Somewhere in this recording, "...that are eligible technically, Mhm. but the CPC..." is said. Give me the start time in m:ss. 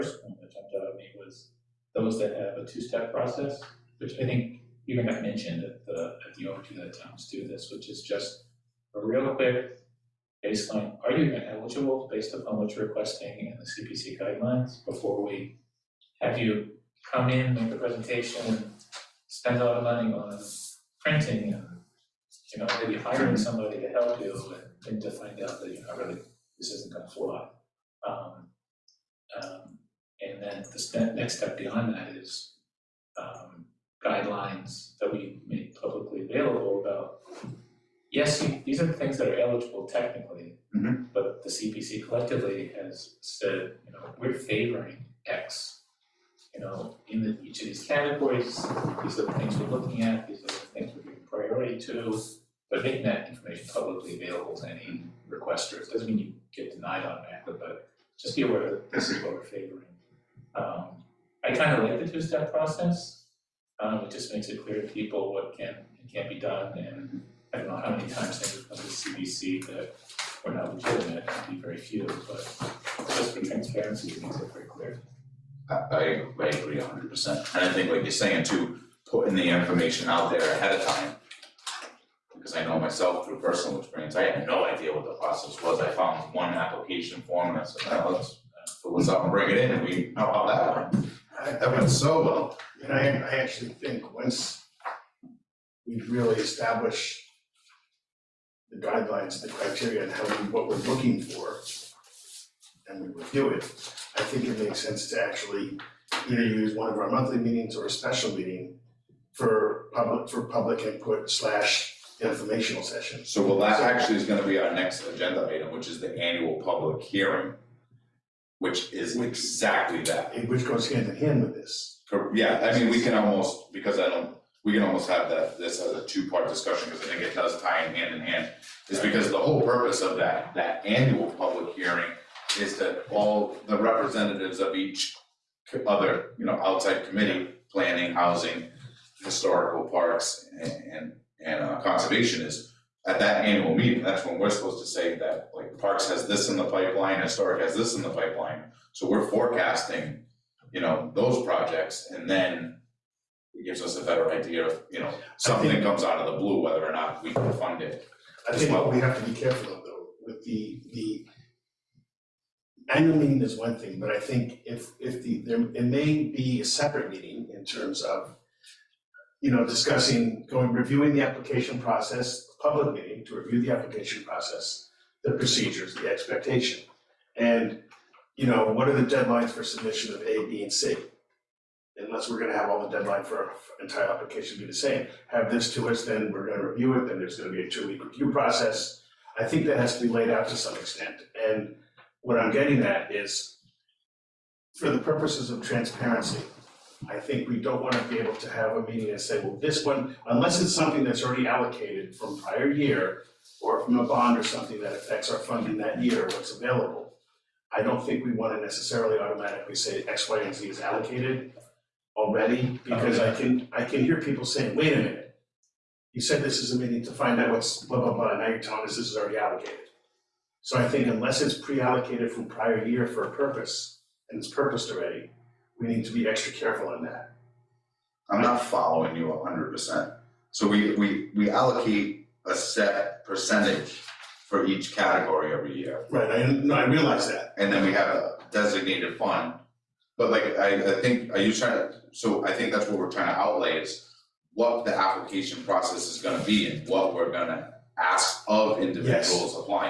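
0:39.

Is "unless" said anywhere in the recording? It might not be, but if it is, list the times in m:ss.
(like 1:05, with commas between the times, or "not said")
3:01, 3:20, 3:41.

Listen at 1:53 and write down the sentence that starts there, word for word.
So well, that actually is gonna be our next agenda item, which is the annual public hearing, which is exactly that.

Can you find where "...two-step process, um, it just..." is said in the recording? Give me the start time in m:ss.
1:02.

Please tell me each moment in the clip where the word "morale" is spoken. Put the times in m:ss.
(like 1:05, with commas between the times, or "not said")
not said.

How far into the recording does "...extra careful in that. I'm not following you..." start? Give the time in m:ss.
3:46.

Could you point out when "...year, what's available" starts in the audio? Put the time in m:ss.
3:26.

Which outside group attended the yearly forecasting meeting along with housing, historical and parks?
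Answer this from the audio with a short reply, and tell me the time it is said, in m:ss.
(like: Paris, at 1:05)
conservation, at 2:21.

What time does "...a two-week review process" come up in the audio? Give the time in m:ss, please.
3:07.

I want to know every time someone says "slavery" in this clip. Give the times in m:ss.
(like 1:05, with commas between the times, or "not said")
not said.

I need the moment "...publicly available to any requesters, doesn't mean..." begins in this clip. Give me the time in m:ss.
0:53.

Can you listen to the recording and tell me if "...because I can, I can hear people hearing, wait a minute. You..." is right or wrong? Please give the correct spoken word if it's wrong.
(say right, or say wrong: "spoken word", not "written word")
wrong: "saying", not "hearing".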